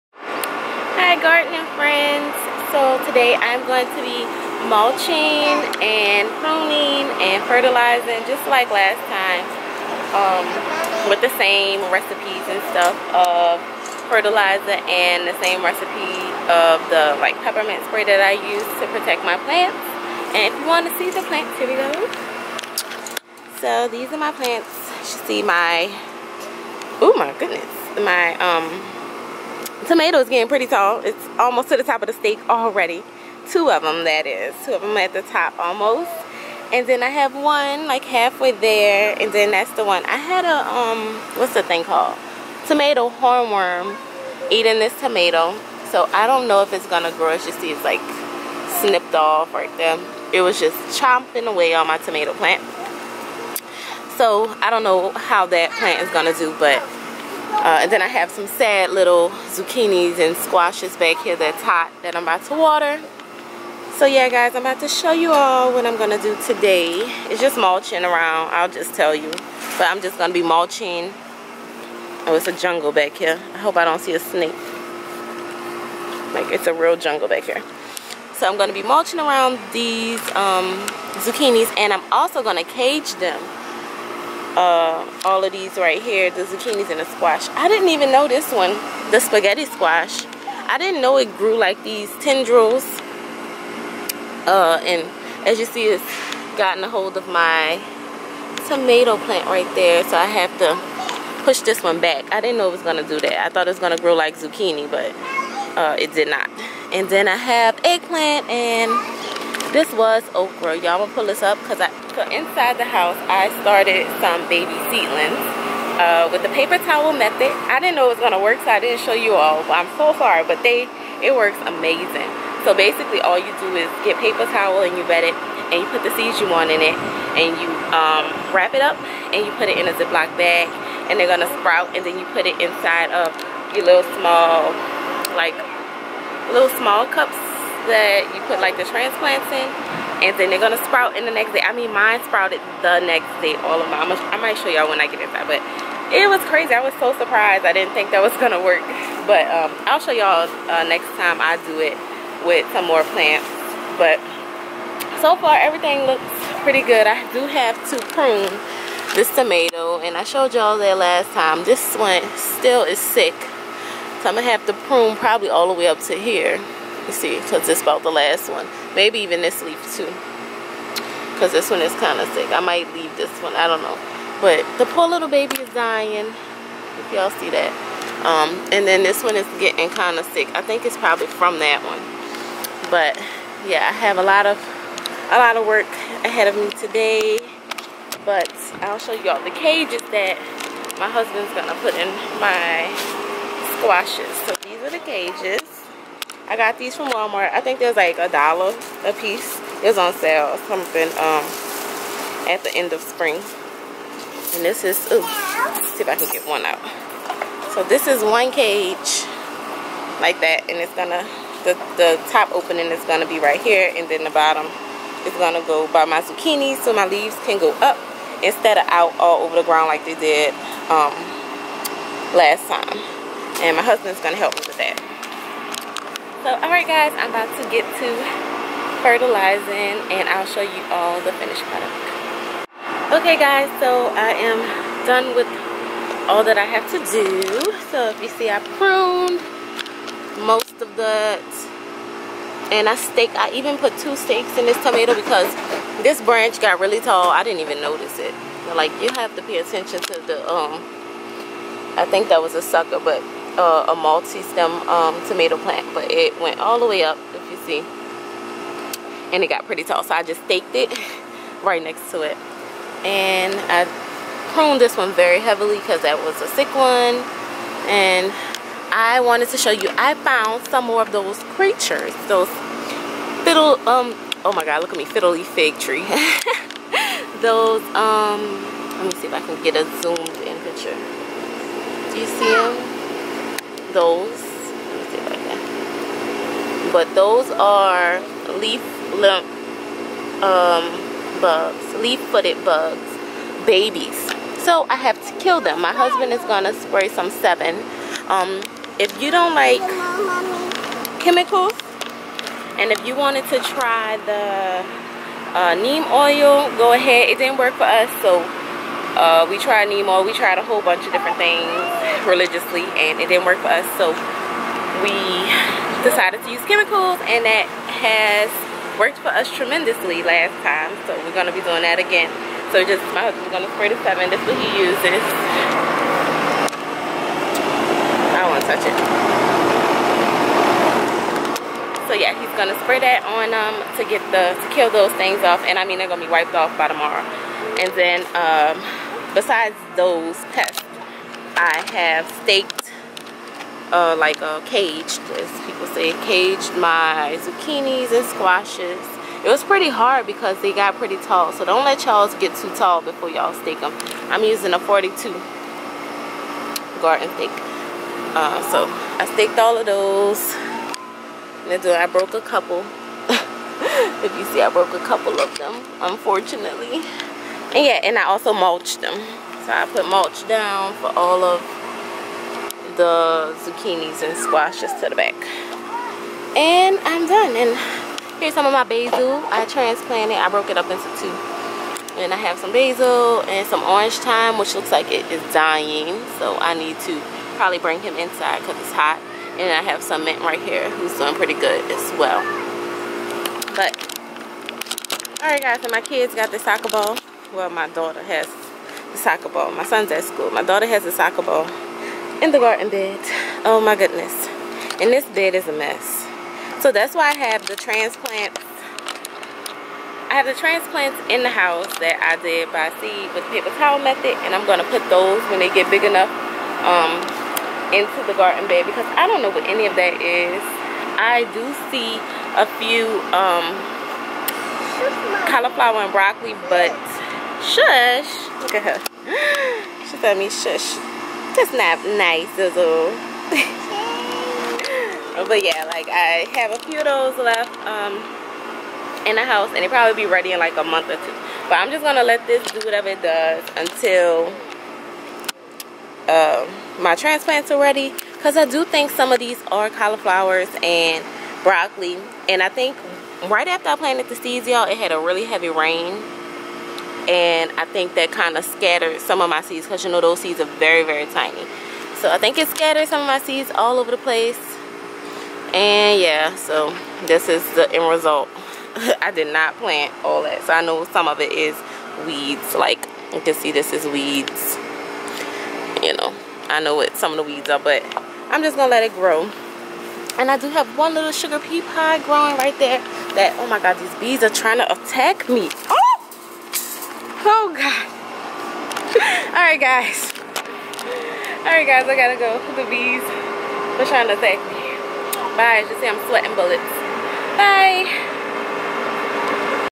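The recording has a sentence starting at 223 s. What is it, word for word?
And my husband's gonna help me with that.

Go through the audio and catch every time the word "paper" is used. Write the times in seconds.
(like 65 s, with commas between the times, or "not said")
116 s, 124 s, 413 s.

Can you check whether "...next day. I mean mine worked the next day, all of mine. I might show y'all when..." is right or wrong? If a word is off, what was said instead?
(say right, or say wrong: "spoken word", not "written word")
wrong: "sprouted", not "worked".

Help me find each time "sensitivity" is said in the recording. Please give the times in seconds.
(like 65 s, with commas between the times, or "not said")
not said.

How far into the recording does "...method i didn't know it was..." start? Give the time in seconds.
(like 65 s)
117 s.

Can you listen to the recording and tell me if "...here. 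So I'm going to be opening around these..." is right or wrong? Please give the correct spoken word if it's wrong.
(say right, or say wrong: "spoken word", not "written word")
wrong: "mulching", not "opening".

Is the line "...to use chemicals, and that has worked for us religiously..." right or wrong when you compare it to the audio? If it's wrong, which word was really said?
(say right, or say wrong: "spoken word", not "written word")
wrong: "tremendously", not "religiously".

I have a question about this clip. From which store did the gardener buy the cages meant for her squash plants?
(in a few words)
Walmart.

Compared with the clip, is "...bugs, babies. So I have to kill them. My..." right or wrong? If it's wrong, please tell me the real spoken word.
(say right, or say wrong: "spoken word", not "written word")
right.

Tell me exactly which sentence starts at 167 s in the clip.
You see, because it's about the last one.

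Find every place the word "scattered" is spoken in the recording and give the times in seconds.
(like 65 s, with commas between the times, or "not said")
458 s, 462 s.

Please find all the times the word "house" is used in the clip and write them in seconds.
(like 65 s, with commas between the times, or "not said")
112 s, 411 s, 439 s.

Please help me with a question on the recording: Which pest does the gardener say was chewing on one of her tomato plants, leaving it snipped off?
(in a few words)
tomato hornworm.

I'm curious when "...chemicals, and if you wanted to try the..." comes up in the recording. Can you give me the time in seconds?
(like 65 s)
301 s.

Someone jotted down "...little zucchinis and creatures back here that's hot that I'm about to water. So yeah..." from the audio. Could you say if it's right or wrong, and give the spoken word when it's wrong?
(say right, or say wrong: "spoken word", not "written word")
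wrong: "squashes", not "creatures".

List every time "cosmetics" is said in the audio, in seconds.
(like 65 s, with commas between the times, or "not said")
not said.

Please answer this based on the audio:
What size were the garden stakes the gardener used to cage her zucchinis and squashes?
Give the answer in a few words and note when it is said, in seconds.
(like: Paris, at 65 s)
42, at 354 s.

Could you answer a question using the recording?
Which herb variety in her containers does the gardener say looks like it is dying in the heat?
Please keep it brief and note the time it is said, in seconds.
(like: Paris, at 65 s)
orange thyme, at 383 s.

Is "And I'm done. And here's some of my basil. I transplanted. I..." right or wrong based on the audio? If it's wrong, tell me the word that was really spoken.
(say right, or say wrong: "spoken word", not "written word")
right.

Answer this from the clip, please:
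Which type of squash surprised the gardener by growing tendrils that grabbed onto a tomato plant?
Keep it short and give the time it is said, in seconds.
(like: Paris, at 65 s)
spaghetti squash, at 89 s.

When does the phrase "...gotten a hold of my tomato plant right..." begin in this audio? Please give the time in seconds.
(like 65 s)
96 s.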